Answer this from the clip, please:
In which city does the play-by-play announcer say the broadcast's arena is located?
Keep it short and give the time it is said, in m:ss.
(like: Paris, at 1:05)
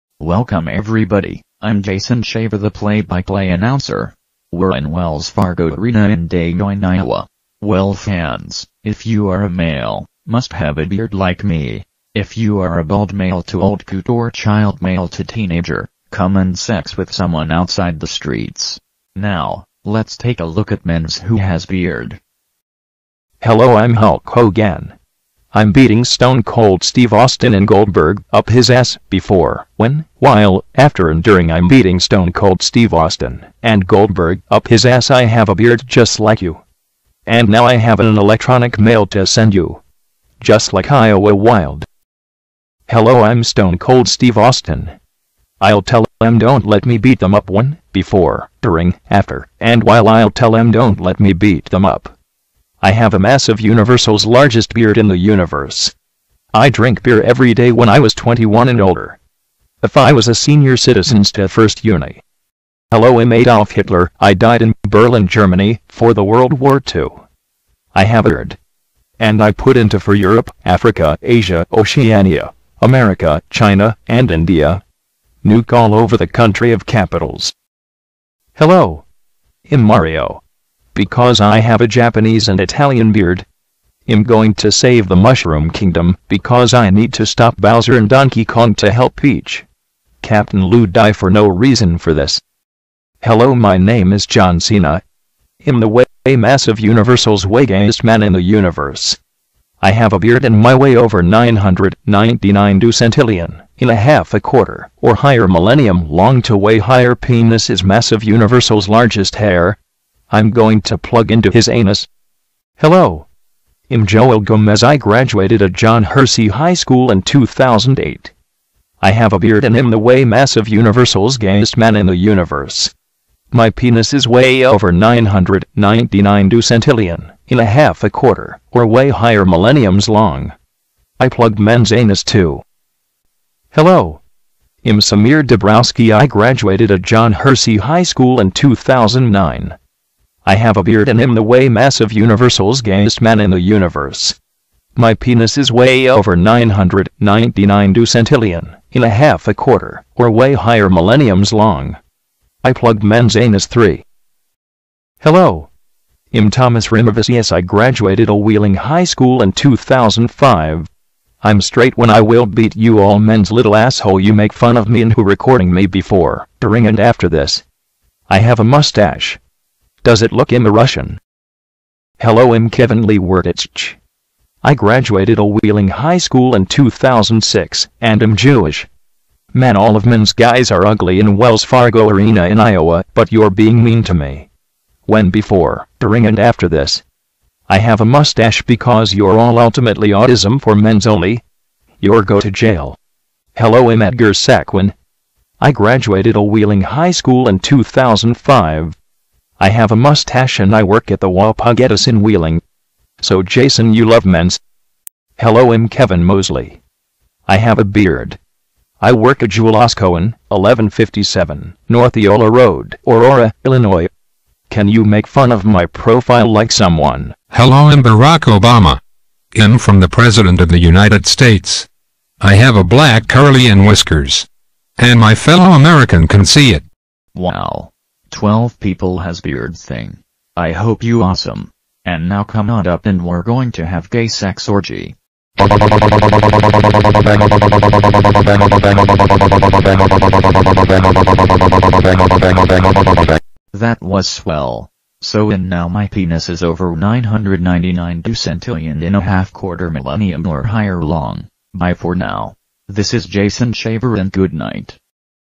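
Des Moines, at 0:06.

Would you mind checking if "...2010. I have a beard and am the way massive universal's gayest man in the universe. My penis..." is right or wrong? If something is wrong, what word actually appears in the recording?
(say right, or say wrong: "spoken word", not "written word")
wrong: "2008", not "2010".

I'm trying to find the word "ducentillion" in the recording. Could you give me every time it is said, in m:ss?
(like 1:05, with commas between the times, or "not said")
1:42, 2:06, 2:27, 4:08.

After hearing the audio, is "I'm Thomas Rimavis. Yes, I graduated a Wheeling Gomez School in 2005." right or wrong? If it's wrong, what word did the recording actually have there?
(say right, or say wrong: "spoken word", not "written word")
wrong: "High", not "Gomez".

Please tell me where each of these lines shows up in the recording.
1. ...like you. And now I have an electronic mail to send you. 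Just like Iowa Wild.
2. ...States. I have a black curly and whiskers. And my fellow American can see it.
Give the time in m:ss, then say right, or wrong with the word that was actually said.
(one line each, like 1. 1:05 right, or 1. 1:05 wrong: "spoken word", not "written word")
1. 0:36 right
2. 3:41 right.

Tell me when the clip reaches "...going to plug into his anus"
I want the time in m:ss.
1:50.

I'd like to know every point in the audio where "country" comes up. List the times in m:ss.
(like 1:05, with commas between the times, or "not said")
1:16.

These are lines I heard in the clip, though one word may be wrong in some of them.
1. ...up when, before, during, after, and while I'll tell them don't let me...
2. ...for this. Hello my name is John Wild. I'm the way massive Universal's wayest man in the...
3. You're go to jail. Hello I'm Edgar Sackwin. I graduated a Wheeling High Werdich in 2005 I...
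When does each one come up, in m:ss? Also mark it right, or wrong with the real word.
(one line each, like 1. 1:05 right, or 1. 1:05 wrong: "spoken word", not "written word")
1. 0:47 right
2. 1:31 wrong: "Cena", not "Wild"
3. 3:11 wrong: "School", not "Werdich".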